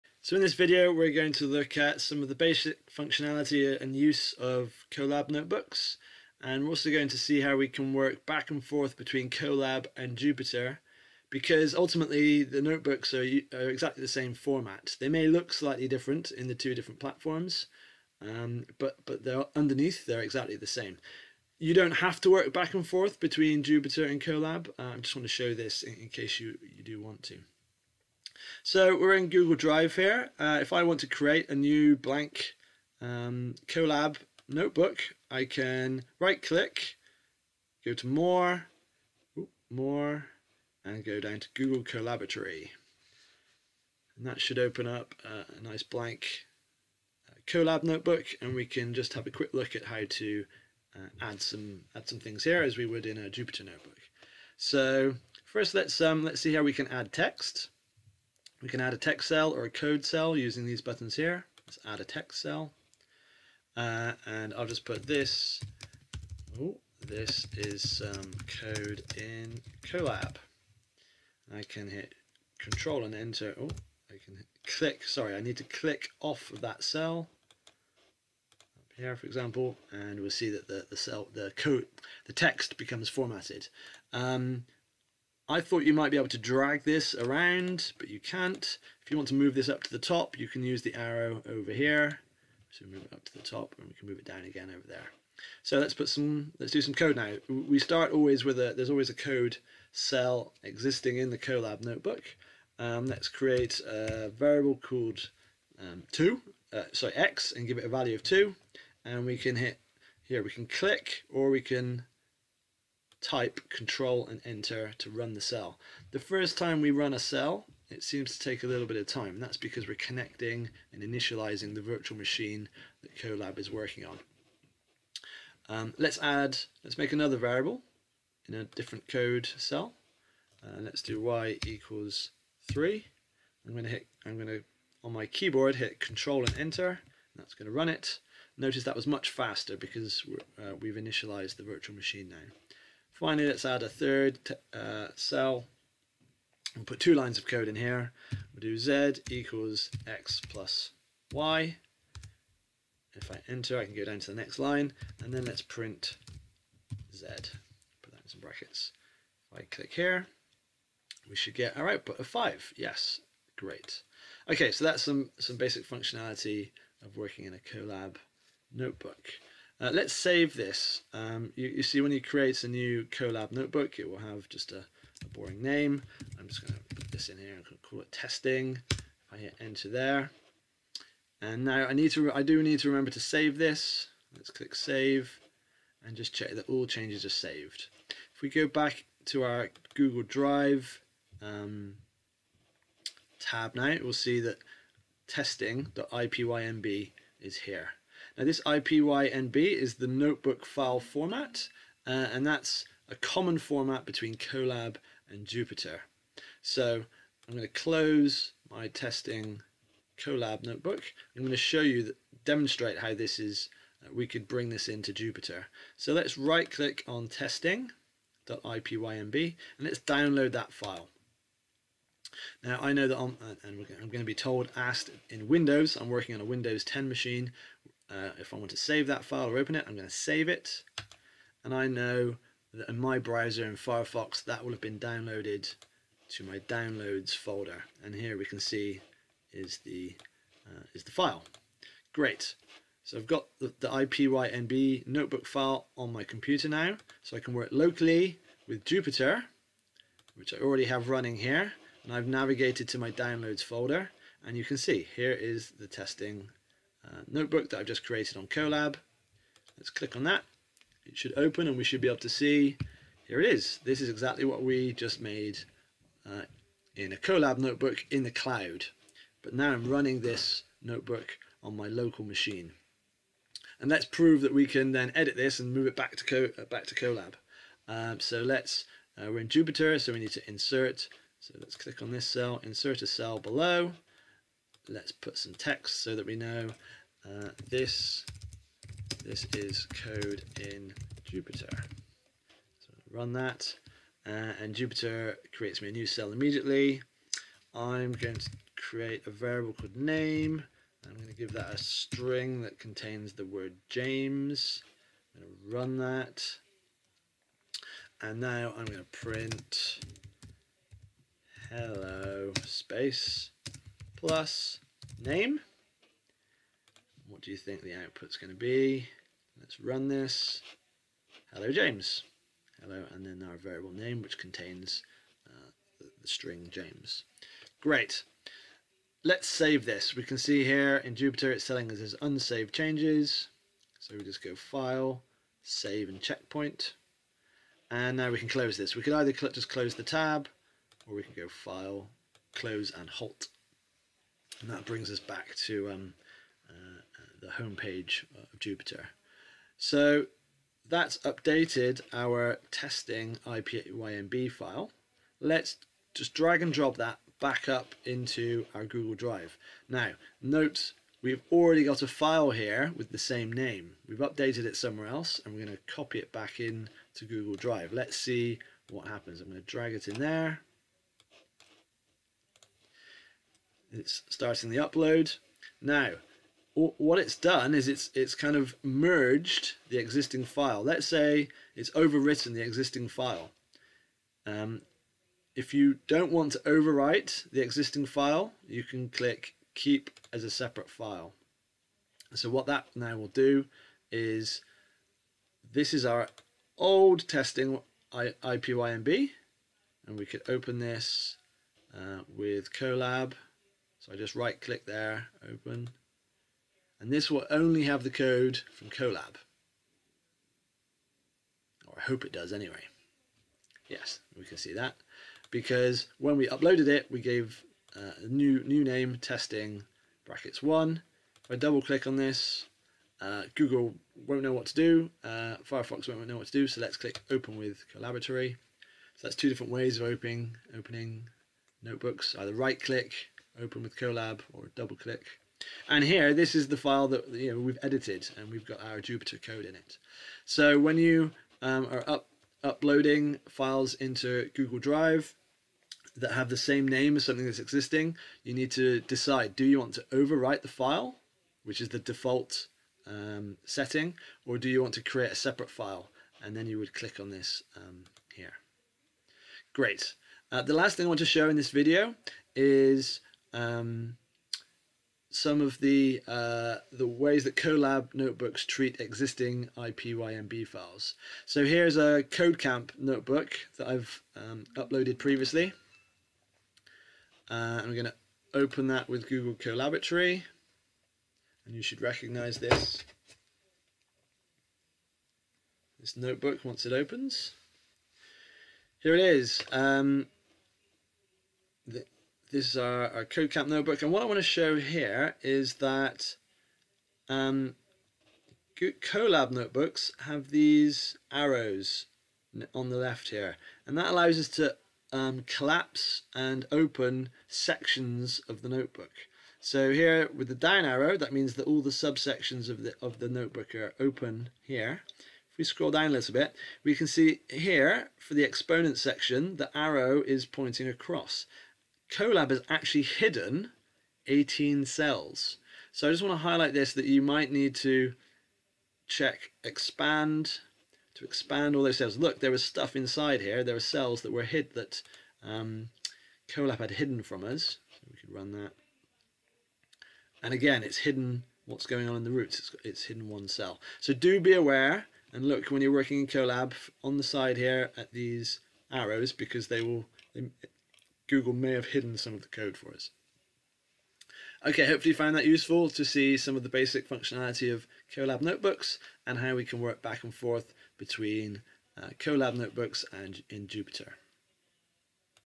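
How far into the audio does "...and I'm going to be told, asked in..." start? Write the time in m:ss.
3:43.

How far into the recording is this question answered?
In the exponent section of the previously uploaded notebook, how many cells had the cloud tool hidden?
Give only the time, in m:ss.
8:43.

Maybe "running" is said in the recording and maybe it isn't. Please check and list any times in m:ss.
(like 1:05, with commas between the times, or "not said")
4:11, 4:29.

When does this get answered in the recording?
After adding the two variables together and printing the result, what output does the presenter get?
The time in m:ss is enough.
2:41.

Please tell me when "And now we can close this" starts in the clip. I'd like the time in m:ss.
5:37.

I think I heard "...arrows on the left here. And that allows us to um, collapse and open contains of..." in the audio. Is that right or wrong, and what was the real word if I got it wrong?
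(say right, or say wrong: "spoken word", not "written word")
wrong: "sections", not "contains".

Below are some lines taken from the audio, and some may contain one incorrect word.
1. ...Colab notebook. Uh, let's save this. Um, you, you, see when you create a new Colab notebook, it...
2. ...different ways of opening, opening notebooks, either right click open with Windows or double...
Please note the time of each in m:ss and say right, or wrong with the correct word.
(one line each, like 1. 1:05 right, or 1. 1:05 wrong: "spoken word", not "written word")
1. 2:47 right
2. 7:09 wrong: "Colab", not "Windows".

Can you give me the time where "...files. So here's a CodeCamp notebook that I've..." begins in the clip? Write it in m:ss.
7:50.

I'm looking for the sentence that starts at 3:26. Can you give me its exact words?
So I'm going to close my testing Colab notebook.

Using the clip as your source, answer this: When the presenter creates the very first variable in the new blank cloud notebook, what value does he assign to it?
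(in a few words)
2.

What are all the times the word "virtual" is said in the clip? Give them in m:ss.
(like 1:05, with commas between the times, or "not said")
2:01, 2:21.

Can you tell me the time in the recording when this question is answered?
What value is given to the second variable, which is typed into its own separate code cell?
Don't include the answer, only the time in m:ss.
2:11.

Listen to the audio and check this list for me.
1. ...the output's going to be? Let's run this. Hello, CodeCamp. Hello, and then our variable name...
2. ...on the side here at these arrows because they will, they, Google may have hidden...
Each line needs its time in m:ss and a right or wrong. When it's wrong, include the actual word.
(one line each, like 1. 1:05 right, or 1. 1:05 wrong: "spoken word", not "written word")
1. 5:17 wrong: "James", not "CodeCamp"
2. 9:07 right.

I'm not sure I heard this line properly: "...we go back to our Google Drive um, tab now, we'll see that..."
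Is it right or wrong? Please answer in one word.
right.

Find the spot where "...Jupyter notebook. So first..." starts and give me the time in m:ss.
0:53.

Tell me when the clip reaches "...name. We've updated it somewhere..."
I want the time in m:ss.
6:03.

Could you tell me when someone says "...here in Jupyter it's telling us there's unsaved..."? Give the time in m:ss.
5:30.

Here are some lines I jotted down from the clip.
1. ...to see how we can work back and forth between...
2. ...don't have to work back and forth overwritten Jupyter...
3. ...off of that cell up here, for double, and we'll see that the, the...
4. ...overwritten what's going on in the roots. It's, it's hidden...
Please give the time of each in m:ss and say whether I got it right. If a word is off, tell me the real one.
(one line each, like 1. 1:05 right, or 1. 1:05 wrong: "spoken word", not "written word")
1. 0:07 right
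2. 0:21 wrong: "between", not "overwritten"
3. 1:16 wrong: "example", not "double"
4. 9:00 wrong: "hidden", not "overwritten".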